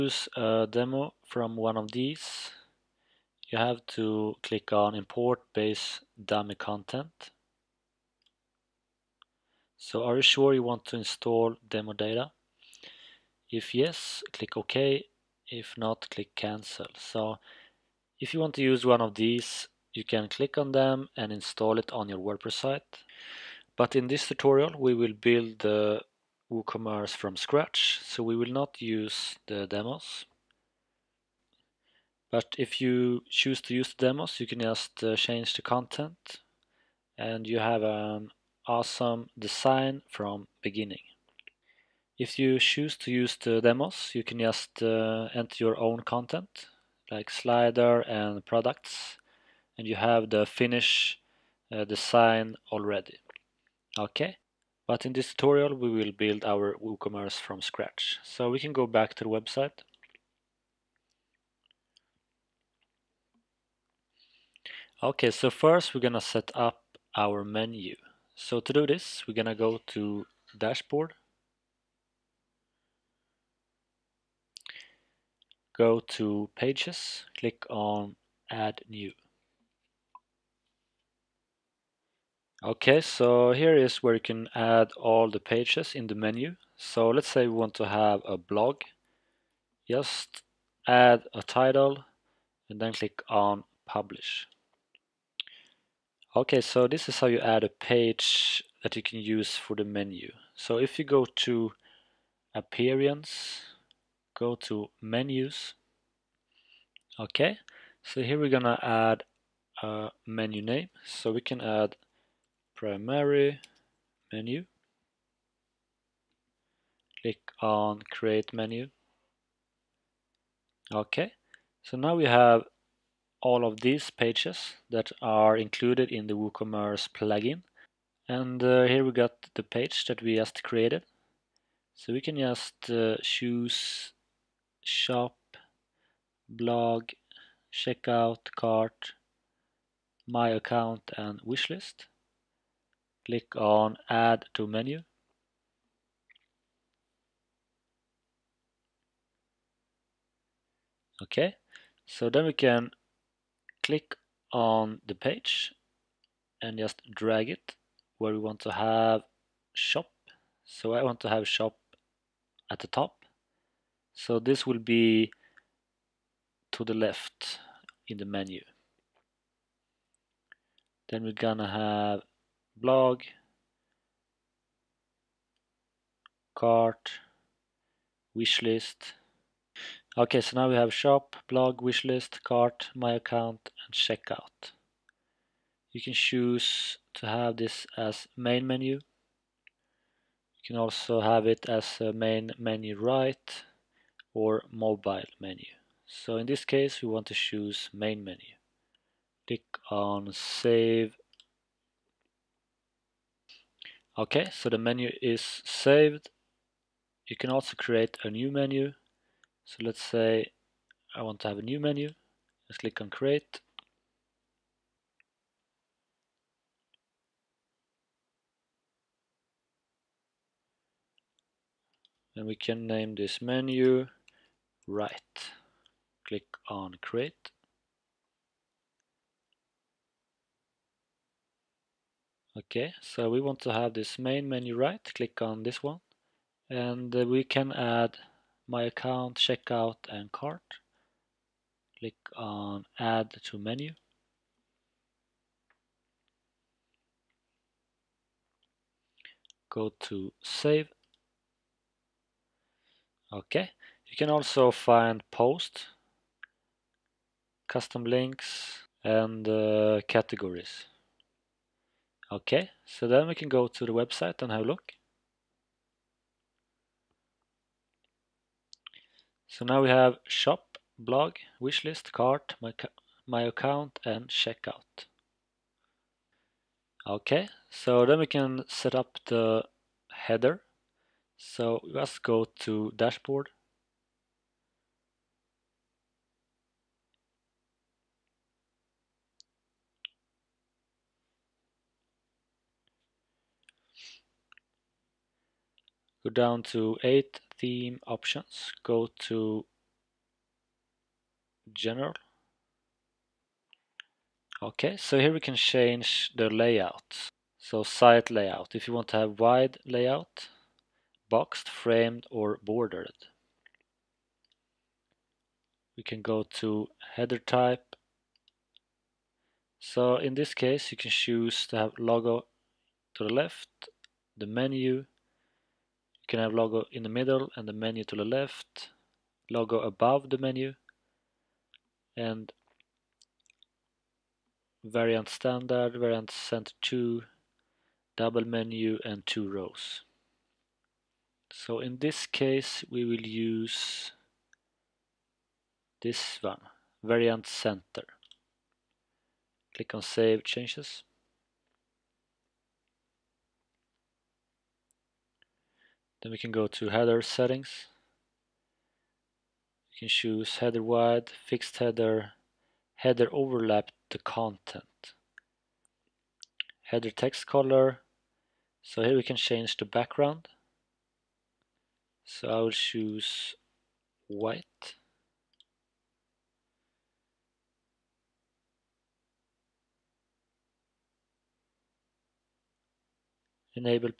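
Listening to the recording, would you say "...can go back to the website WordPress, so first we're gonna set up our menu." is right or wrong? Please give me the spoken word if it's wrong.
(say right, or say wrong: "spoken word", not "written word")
wrong: "Okay", not "WordPress".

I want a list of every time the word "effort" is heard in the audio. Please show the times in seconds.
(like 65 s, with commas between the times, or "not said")
not said.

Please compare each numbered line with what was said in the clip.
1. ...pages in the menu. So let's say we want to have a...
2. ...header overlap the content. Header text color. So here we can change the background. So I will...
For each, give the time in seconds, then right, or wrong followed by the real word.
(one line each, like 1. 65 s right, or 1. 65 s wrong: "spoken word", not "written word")
1. 85 s right
2. 362 s right.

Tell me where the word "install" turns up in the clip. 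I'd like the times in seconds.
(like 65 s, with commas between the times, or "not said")
10 s, 21 s.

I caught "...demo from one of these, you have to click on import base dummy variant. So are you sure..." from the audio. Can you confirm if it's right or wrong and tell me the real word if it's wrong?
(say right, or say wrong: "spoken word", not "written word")
wrong: "content", not "variant".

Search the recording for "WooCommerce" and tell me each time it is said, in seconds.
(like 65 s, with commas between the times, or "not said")
26 s, 56 s, 126 s.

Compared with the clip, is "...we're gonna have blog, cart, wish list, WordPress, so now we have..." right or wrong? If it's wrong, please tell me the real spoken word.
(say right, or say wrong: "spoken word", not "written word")
wrong: "Okay", not "WordPress".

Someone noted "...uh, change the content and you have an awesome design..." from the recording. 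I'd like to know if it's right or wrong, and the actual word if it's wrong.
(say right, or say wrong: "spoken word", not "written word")
right.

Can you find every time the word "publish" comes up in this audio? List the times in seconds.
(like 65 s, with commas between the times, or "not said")
93 s.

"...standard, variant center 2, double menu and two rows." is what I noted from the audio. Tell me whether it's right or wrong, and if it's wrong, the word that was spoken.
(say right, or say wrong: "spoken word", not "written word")
right.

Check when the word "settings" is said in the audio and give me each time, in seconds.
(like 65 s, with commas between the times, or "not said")
357 s.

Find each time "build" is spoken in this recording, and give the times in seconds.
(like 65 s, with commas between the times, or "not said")
25 s, 56 s.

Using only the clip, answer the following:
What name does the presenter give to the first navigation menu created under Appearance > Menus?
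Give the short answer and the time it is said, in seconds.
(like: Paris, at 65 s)
Primary menu, at 112 s.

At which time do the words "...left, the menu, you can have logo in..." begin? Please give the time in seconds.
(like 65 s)
323 s.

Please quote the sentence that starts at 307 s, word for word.
So site layout, if you want to have wide layout, boxed, framed or bordered.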